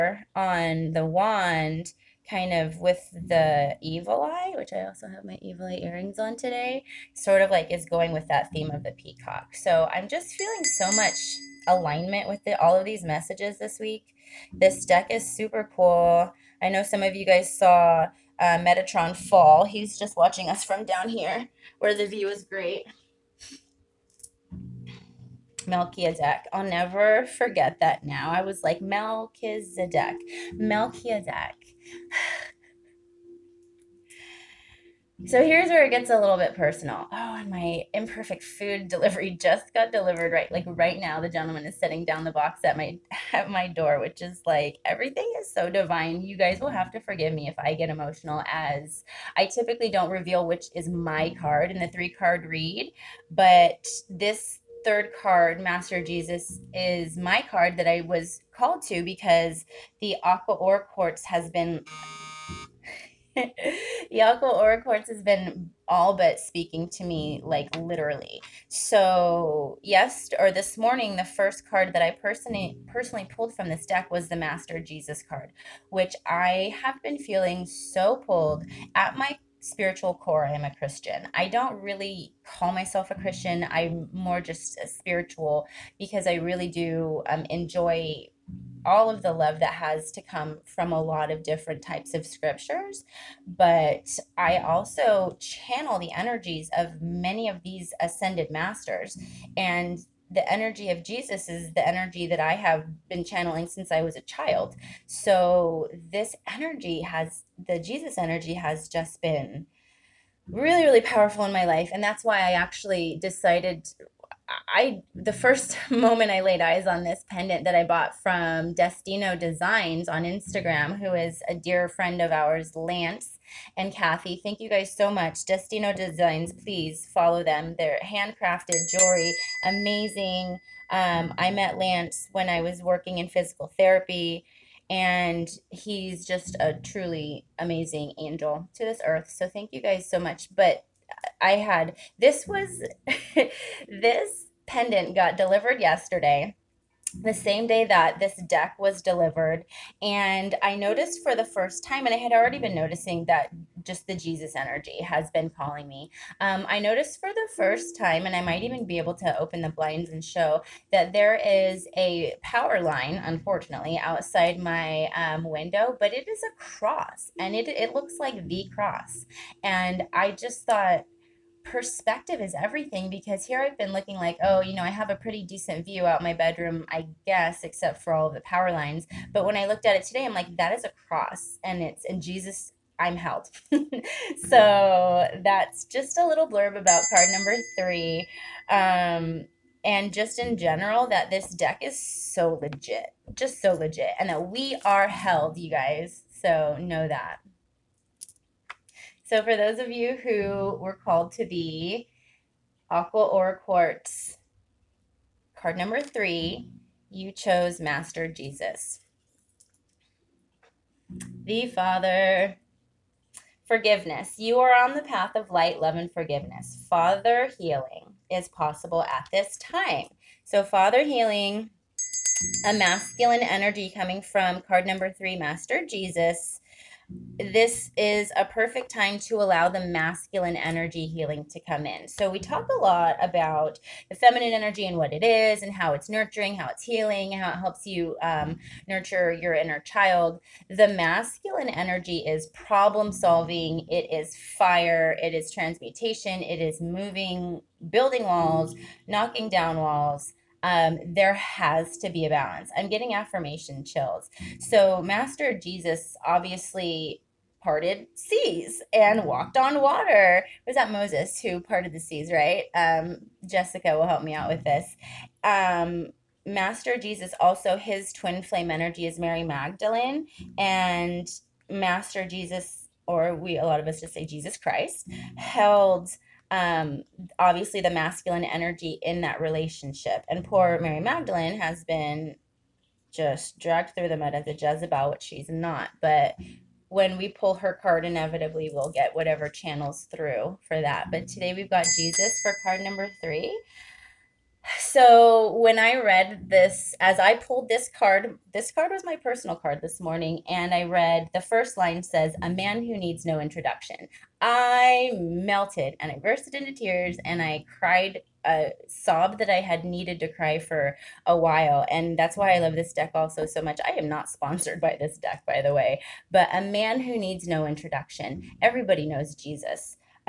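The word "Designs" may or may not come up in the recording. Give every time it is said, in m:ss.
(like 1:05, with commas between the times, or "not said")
1:59, 2:05.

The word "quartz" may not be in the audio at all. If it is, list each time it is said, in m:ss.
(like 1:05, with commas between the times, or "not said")
1:00, 3:23.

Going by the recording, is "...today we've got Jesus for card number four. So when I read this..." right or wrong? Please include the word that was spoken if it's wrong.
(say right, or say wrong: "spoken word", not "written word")
wrong: "three", not "four".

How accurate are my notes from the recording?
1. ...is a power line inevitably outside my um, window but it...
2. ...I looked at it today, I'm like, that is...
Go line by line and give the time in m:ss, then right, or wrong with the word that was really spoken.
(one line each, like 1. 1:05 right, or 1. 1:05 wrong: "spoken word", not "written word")
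1. 2:41 wrong: "unfortunately", not "inevitably"
2. 2:59 right.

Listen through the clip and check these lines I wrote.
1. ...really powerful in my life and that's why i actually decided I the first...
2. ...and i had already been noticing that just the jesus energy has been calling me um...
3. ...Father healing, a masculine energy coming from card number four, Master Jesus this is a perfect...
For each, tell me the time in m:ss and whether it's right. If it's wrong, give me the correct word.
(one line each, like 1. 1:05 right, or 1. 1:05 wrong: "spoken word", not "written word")
1. 1:50 right
2. 2:32 right
3. 3:40 wrong: "three", not "four".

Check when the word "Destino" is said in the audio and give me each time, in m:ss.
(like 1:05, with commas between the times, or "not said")
1:58, 2:05.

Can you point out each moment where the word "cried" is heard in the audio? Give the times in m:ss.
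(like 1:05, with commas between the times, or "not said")
5:07.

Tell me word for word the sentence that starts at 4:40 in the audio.
And poor Mary Magdalene has been just dragged through the mud as a Jezebel, which she's not.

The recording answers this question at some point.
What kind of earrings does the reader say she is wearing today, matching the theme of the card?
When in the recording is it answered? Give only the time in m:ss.
0:05.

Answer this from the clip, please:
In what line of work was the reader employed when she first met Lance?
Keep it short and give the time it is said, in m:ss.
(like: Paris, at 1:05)
Physical therapy, at 2:13.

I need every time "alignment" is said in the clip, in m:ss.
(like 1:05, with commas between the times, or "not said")
0:11.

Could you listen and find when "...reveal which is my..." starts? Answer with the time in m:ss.
0:50.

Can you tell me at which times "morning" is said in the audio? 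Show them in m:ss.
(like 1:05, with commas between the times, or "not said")
1:10, 4:59.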